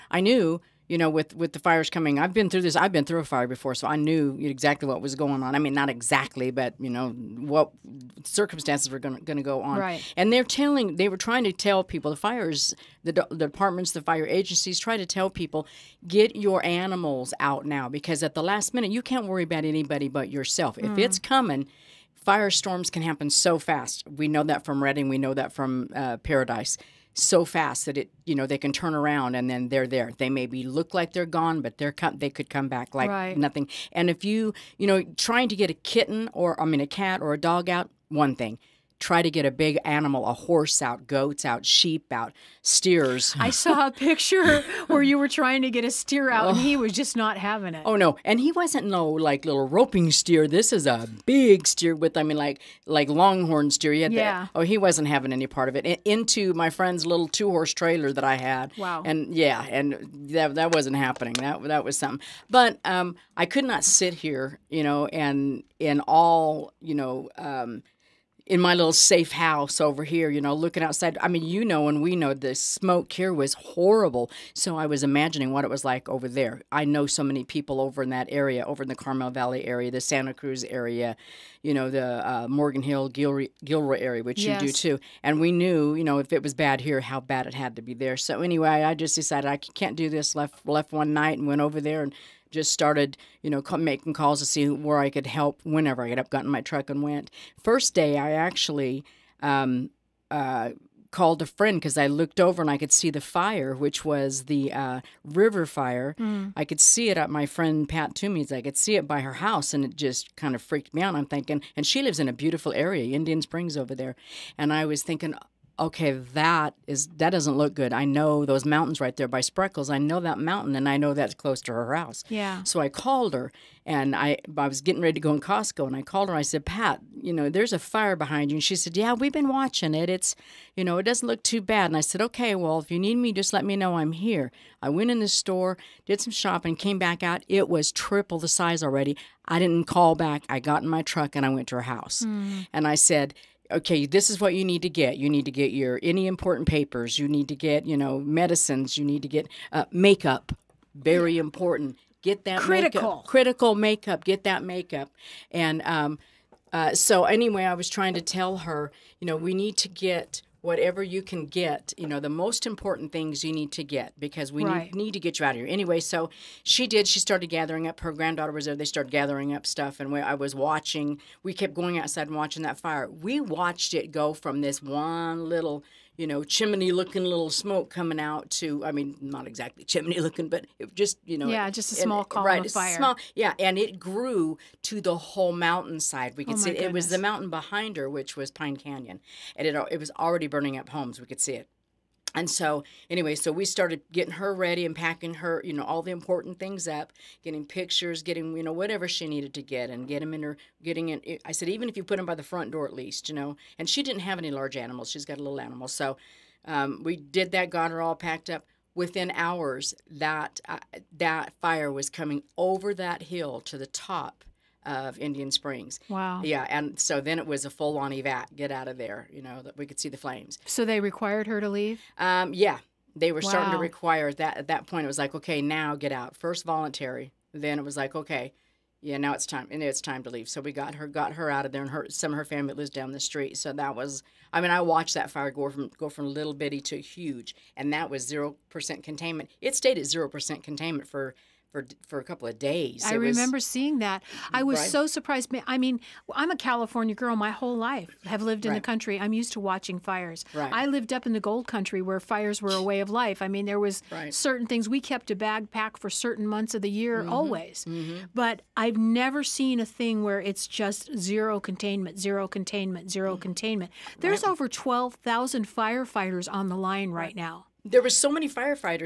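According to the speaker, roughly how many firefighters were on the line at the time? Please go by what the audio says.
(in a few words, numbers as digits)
12,000.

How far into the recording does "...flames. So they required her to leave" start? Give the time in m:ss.
3:40.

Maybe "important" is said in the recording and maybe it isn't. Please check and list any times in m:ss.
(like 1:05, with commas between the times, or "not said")
2:26, 2:31, 2:42, 3:16.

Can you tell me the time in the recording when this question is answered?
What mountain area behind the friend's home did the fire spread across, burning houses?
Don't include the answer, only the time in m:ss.
3:08.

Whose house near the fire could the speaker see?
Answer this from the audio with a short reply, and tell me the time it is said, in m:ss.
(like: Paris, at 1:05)
Pat Toomey, at 1:47.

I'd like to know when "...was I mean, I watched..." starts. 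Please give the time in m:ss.
3:53.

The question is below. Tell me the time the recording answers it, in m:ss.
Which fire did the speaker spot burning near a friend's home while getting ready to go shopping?
1:45.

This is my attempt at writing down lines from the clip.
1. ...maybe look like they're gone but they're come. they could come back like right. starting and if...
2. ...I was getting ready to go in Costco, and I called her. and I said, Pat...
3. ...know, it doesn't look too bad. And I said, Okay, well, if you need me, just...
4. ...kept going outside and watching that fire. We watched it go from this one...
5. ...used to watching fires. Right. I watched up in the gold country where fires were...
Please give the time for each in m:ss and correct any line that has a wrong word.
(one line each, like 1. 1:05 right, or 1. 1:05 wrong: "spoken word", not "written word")
1. 0:30 wrong: "nothing", not "starting"
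2. 2:04 right
3. 2:10 right
4. 2:51 right
5. 4:09 wrong: "lived", not "watched".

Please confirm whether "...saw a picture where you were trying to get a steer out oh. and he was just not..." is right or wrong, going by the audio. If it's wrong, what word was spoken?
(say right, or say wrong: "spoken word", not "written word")
right.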